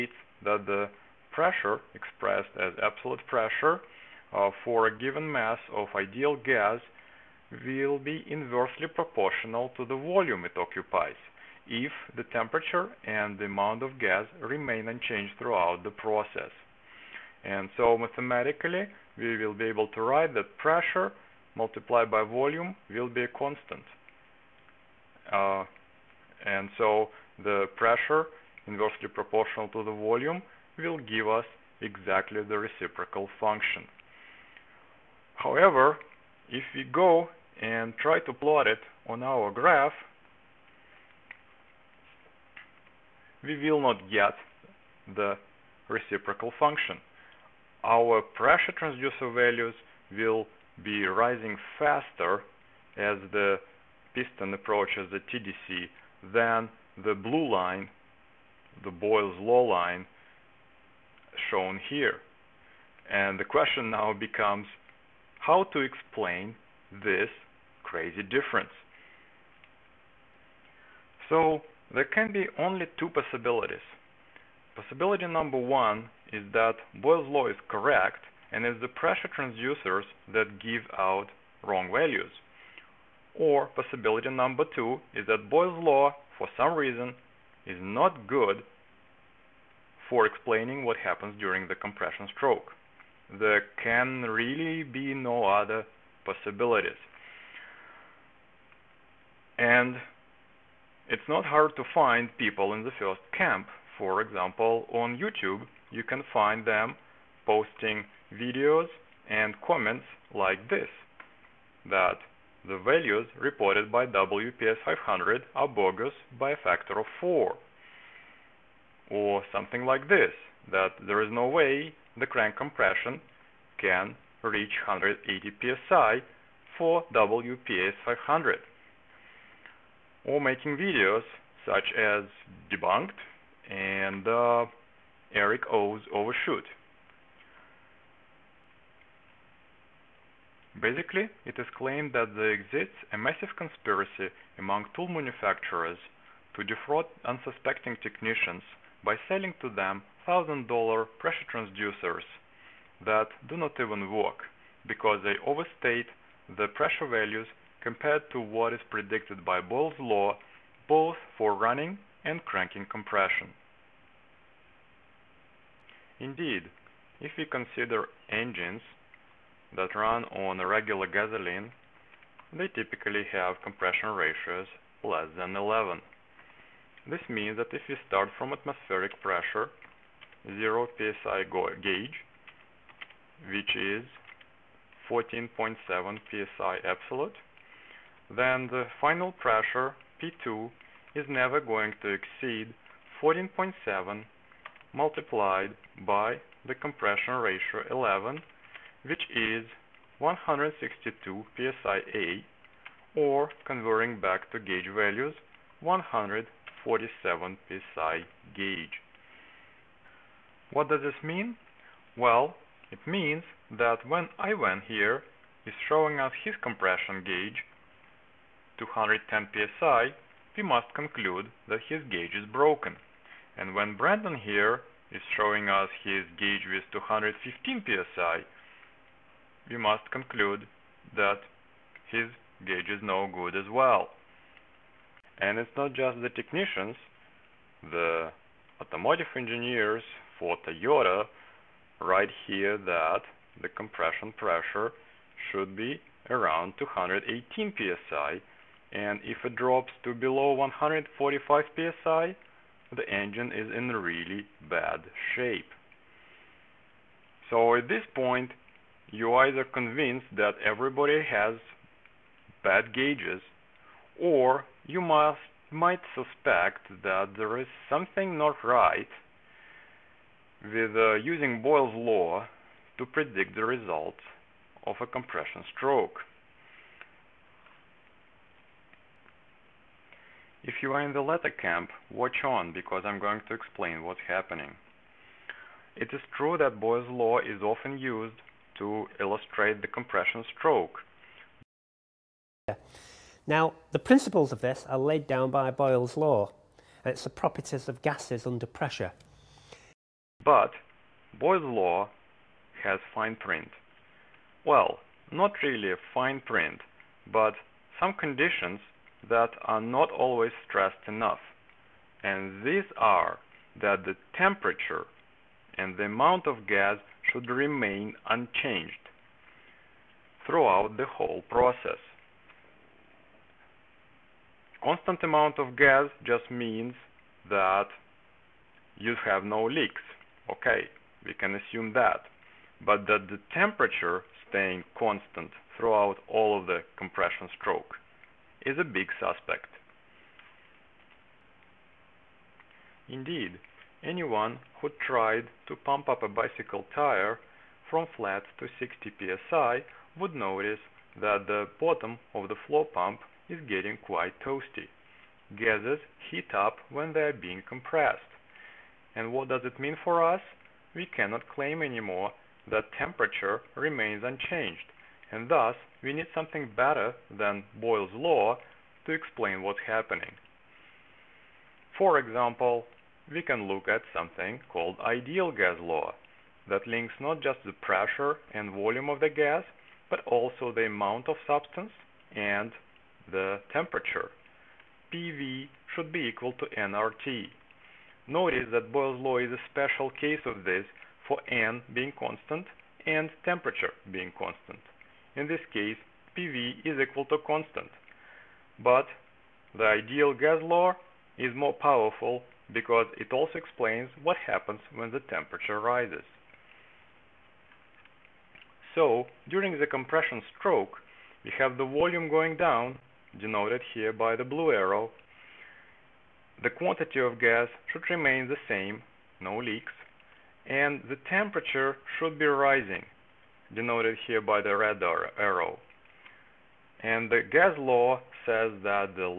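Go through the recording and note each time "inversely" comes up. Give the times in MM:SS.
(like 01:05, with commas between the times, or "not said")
00:08, 00:28.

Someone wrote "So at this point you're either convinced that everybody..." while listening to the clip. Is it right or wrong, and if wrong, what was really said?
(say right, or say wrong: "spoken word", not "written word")
right.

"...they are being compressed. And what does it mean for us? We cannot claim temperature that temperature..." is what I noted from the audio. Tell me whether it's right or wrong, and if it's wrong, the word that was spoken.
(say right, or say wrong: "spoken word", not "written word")
wrong: "anymore", not "temperature".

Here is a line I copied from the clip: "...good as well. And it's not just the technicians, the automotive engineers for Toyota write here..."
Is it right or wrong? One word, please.
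right.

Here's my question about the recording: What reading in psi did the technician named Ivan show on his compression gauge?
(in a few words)
210 psi.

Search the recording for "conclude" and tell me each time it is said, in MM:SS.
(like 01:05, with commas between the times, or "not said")
03:40, 03:50.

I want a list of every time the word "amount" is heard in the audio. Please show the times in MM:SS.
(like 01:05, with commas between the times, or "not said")
00:13, 05:16, 05:25, 06:20.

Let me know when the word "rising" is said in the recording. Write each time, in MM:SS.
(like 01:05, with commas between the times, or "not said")
00:51, 07:02.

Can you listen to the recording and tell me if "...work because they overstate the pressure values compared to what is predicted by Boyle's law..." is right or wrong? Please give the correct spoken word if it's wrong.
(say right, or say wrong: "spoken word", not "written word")
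right.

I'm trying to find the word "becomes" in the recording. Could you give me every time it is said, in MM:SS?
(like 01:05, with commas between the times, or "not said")
01:04.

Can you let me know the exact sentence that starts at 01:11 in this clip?
So there can be only two possibilities.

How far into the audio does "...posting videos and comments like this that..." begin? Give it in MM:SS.
01:47.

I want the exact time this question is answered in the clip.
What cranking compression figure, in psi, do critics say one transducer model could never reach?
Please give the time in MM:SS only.
02:04.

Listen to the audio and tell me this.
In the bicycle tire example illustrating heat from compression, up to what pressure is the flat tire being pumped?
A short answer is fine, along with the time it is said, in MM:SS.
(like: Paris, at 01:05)
60 psi, at 05:48.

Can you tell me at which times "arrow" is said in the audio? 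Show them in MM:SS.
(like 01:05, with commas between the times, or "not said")
06:54, 07:05.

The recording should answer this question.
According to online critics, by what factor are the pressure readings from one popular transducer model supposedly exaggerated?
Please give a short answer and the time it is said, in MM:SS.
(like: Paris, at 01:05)
4, at 01:56.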